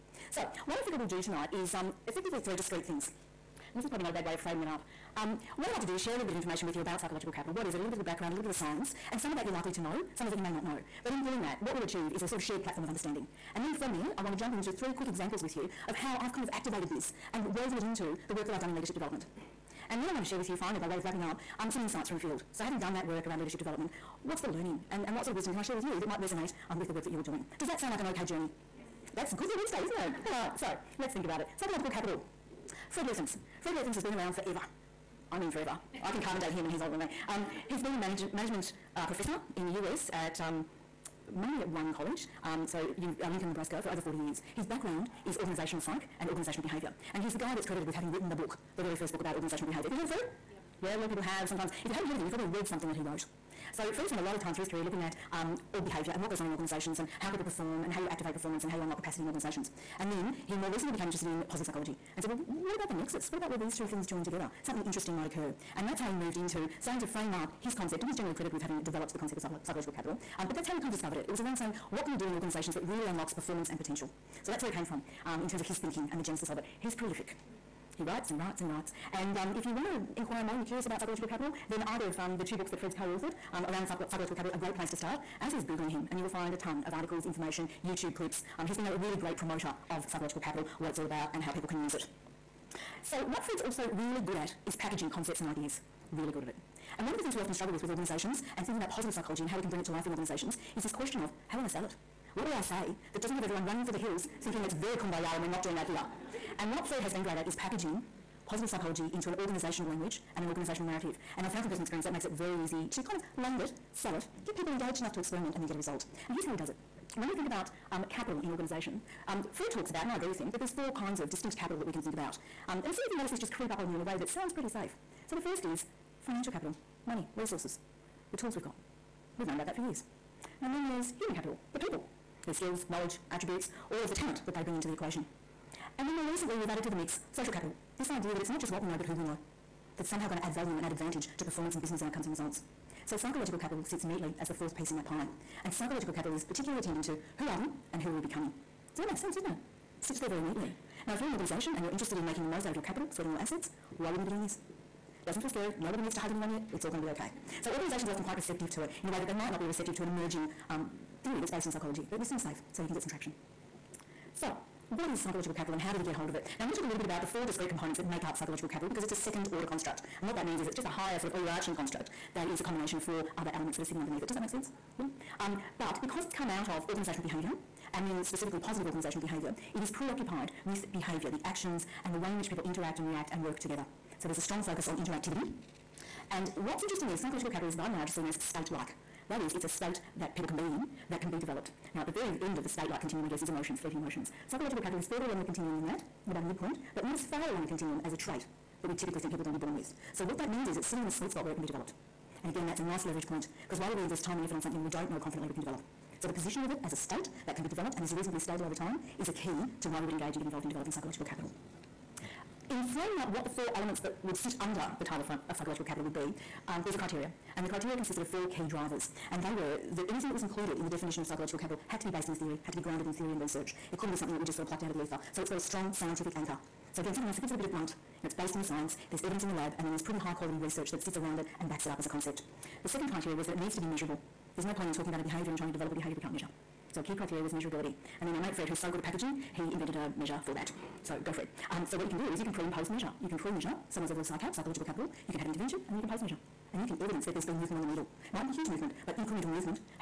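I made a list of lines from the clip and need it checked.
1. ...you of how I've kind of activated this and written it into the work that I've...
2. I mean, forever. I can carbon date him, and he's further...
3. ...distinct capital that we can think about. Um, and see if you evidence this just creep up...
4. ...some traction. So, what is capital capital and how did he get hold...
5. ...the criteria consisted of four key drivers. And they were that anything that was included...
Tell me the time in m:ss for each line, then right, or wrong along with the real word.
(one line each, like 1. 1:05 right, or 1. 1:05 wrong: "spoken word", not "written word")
1. 0:15 wrong: "woven", not "written"
2. 0:35 wrong: "older", not "further"
3. 2:01 wrong: "notice", not "evidence"
4. 2:43 wrong: "psychological", not "capital"
5. 3:37 right.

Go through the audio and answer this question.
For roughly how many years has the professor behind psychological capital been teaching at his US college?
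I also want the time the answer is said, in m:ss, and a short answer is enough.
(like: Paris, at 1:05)
over 40 years, at 0:43.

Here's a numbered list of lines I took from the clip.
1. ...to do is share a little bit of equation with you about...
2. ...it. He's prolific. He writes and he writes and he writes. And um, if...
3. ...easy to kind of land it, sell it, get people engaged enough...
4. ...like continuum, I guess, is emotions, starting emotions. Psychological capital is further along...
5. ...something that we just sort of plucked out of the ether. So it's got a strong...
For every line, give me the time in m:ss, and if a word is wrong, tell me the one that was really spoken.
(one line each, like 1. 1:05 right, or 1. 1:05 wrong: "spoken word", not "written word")
1. 0:05 wrong: "information", not "equation"
2. 1:16 right
3. 1:52 right
4. 3:12 wrong: "fleeting", not "starting"
5. 3:44 right.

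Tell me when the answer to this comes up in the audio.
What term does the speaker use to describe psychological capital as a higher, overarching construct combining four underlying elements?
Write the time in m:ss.
2:49.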